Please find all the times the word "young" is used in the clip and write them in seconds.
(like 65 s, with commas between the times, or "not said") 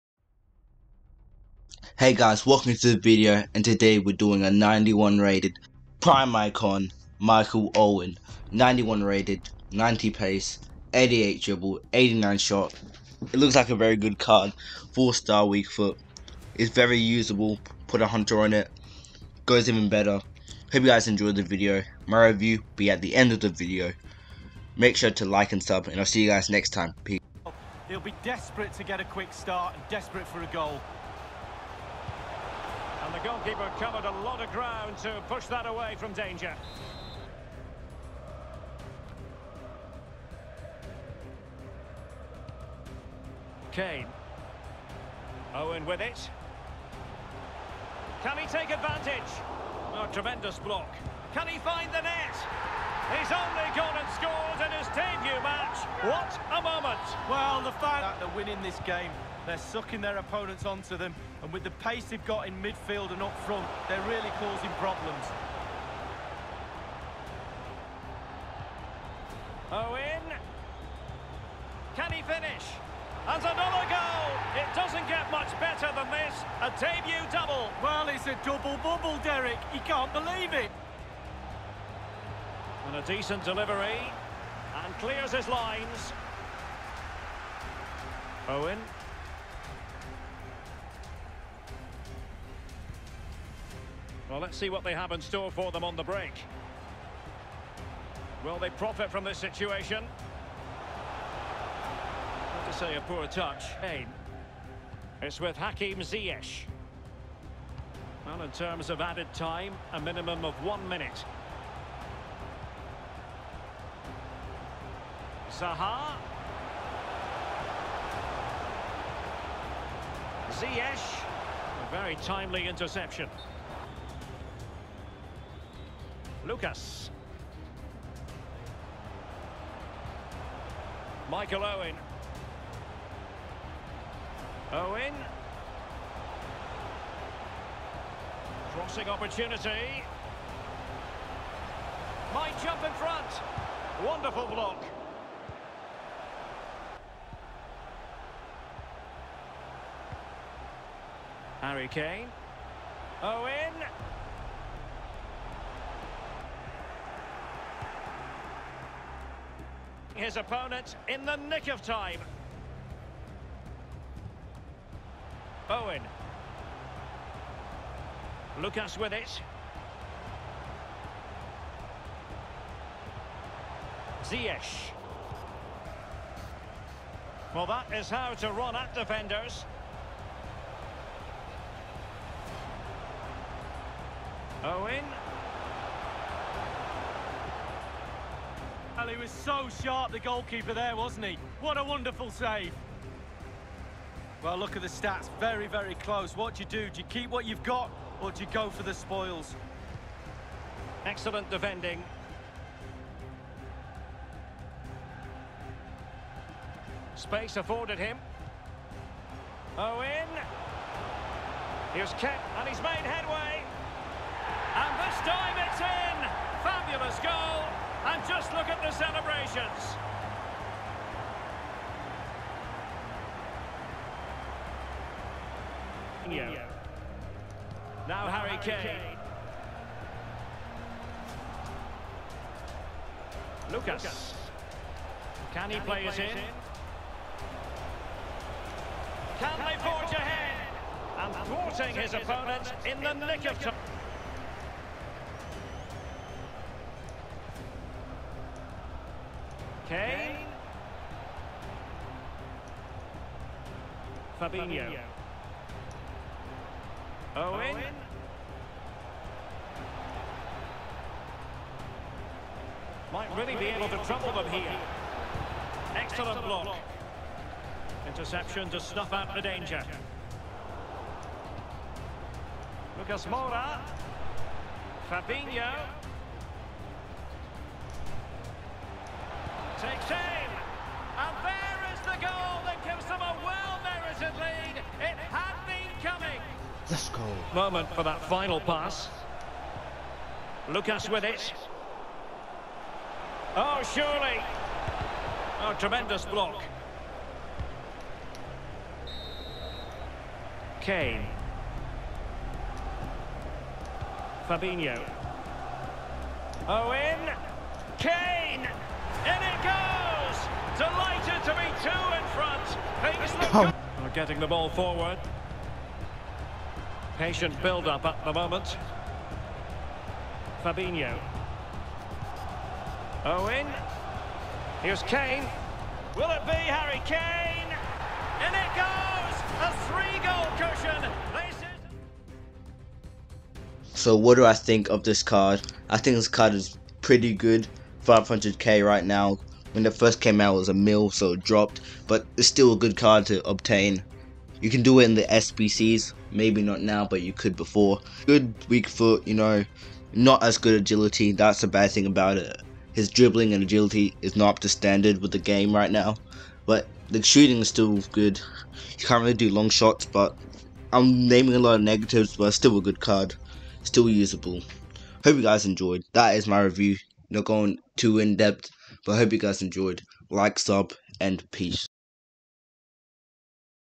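not said.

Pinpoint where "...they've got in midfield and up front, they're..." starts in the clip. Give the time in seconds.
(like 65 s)
62 s.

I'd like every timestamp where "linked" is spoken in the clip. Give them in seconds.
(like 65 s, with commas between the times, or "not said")
not said.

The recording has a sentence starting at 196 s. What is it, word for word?
Do you keep what you've got, or do you go for the spoils?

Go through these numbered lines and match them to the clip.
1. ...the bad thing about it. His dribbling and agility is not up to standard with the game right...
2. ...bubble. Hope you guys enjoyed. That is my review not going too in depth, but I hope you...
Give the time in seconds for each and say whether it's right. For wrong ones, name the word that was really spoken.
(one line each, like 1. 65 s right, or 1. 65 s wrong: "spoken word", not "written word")
1. 351 s right
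2. 364 s wrong: "usable", not "bubble".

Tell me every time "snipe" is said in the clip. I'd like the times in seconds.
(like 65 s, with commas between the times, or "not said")
not said.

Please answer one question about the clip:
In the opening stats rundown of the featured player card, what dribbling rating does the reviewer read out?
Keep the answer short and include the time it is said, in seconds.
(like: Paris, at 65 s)
88, at 10 s.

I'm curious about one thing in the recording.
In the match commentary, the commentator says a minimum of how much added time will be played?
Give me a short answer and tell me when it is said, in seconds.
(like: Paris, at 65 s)
One minute, at 109 s.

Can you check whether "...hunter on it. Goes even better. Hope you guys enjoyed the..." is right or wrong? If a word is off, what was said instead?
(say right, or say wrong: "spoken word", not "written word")
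right.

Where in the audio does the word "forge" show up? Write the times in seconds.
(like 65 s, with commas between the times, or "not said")
239 s.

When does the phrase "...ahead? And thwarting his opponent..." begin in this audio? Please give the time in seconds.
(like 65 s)
240 s.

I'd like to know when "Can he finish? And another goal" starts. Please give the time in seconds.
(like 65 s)
71 s.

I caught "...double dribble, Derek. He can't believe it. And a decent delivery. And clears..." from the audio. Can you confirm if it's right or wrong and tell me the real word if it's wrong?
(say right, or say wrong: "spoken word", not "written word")
wrong: "bubble", not "dribble".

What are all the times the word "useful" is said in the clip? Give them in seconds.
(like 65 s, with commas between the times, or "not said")
not said.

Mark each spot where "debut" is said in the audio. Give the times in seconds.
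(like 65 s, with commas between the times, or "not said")
54 s, 76 s.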